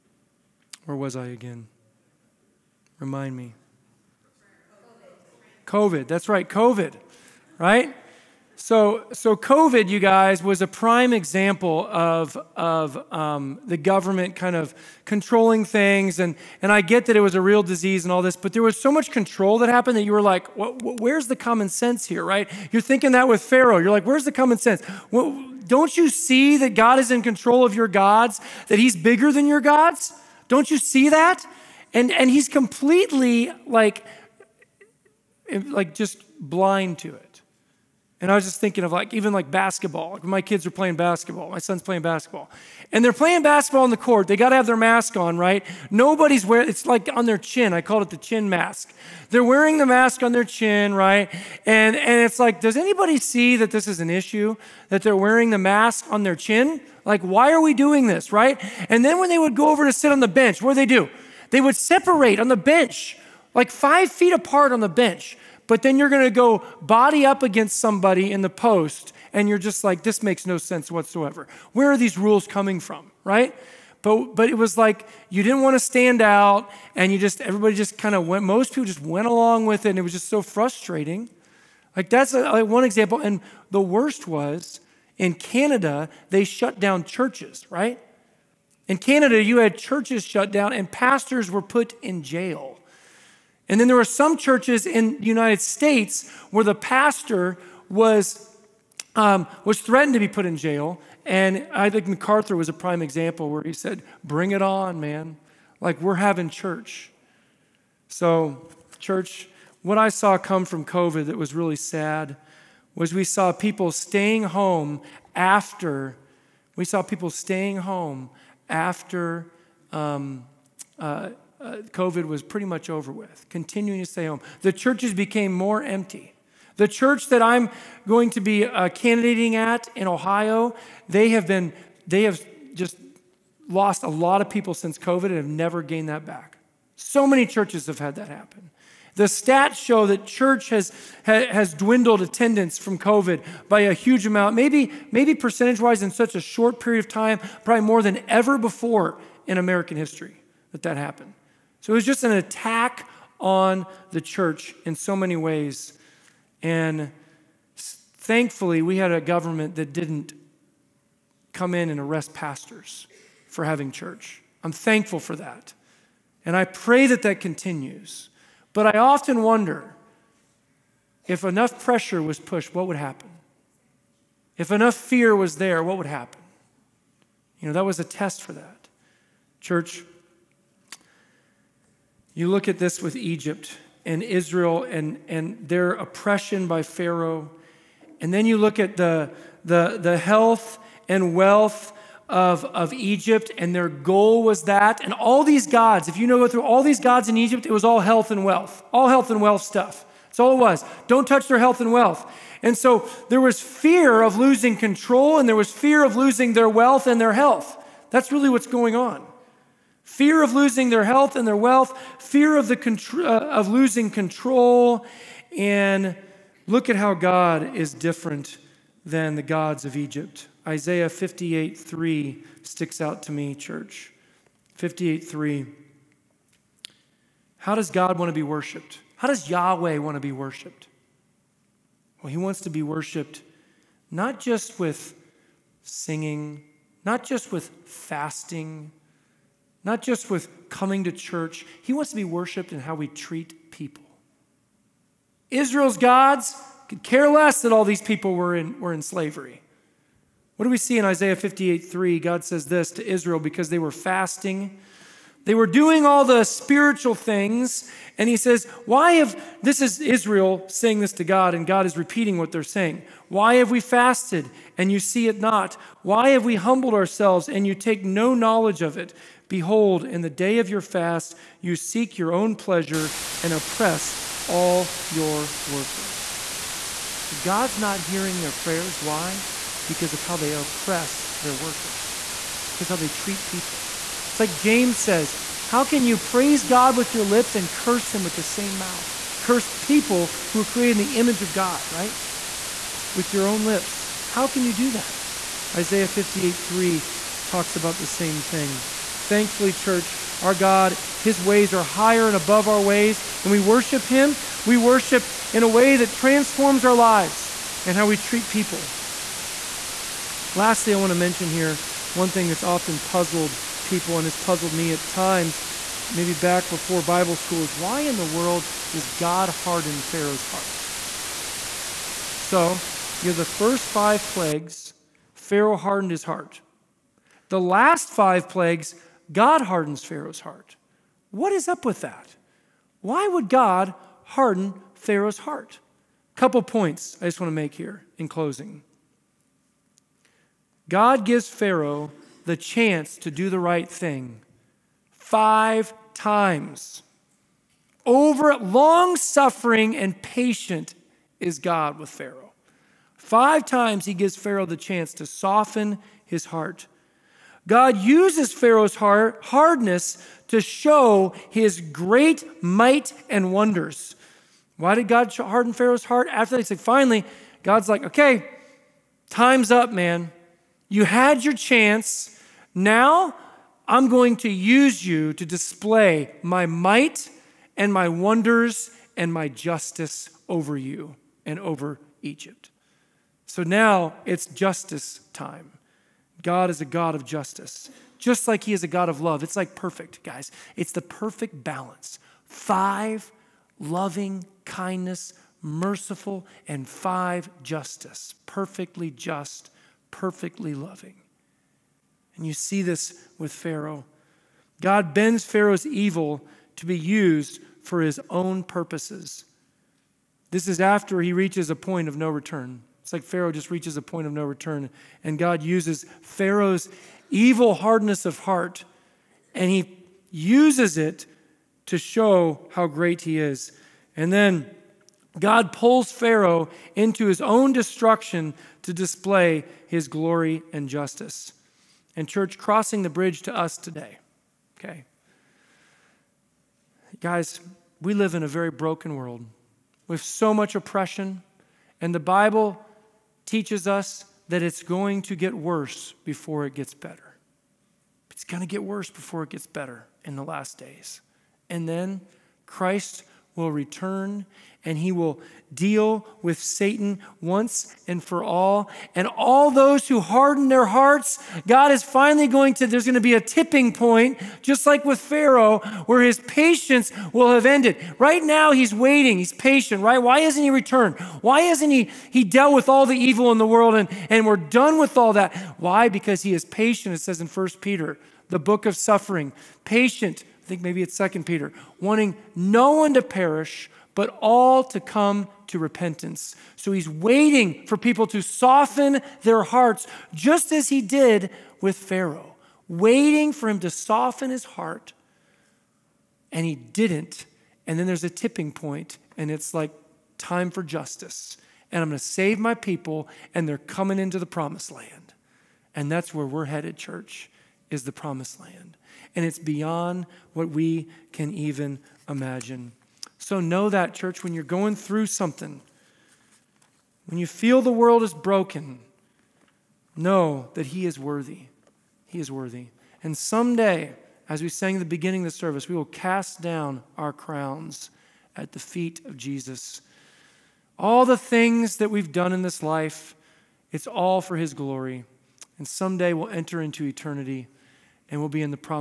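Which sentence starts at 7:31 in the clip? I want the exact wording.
And then Christ will return and he will deal with Satan once and for all.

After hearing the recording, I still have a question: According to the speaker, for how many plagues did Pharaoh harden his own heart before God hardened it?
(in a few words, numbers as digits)
5.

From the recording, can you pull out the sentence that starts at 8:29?
And it's beyond what we can even imagine.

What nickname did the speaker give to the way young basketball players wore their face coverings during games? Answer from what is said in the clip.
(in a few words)
chin mask.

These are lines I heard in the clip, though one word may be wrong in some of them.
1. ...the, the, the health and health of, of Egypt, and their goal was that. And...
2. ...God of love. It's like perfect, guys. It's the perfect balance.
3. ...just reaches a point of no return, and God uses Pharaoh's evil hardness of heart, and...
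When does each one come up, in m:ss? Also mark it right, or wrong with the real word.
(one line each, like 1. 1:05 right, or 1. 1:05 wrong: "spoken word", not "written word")
1. 3:08 wrong: "wealth", not "health"
2. 6:28 right
3. 6:53 right.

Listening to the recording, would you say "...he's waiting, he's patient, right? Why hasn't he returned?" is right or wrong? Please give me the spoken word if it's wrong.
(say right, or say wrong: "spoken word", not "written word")
right.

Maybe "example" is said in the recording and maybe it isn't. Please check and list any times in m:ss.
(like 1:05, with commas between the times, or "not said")
0:11, 1:22, 1:42.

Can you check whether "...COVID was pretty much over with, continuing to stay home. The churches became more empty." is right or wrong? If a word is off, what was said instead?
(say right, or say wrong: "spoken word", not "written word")
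right.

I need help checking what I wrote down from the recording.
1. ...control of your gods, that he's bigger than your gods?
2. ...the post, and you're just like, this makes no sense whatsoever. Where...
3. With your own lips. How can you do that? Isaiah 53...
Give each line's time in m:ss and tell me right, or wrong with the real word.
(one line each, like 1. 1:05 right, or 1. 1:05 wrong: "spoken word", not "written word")
1. 0:27 right
2. 1:08 right
3. 4:53 wrong: "58", not "53".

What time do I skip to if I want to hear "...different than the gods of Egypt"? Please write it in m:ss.
3:37.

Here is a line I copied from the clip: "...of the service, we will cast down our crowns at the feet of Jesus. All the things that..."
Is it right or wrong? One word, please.
right.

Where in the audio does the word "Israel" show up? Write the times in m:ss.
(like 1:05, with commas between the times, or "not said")
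3:04, 4:05, 4:13, 4:20.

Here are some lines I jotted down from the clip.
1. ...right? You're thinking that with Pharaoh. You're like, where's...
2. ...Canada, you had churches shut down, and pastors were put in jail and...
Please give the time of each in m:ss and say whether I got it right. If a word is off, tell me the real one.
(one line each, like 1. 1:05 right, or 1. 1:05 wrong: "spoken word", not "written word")
1. 0:22 right
2. 1:28 right.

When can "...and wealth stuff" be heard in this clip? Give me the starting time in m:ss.
3:19.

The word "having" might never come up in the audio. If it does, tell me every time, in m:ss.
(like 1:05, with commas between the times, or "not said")
1:46, 2:43.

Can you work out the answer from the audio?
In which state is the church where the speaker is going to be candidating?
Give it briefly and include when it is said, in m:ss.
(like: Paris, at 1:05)
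Ohio, at 2:10.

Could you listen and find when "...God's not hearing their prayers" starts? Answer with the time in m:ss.
4:37.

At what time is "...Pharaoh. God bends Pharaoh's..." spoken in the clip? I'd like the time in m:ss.
6:43.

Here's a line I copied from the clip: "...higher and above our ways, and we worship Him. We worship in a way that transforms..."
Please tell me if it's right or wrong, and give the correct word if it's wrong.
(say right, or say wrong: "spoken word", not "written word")
right.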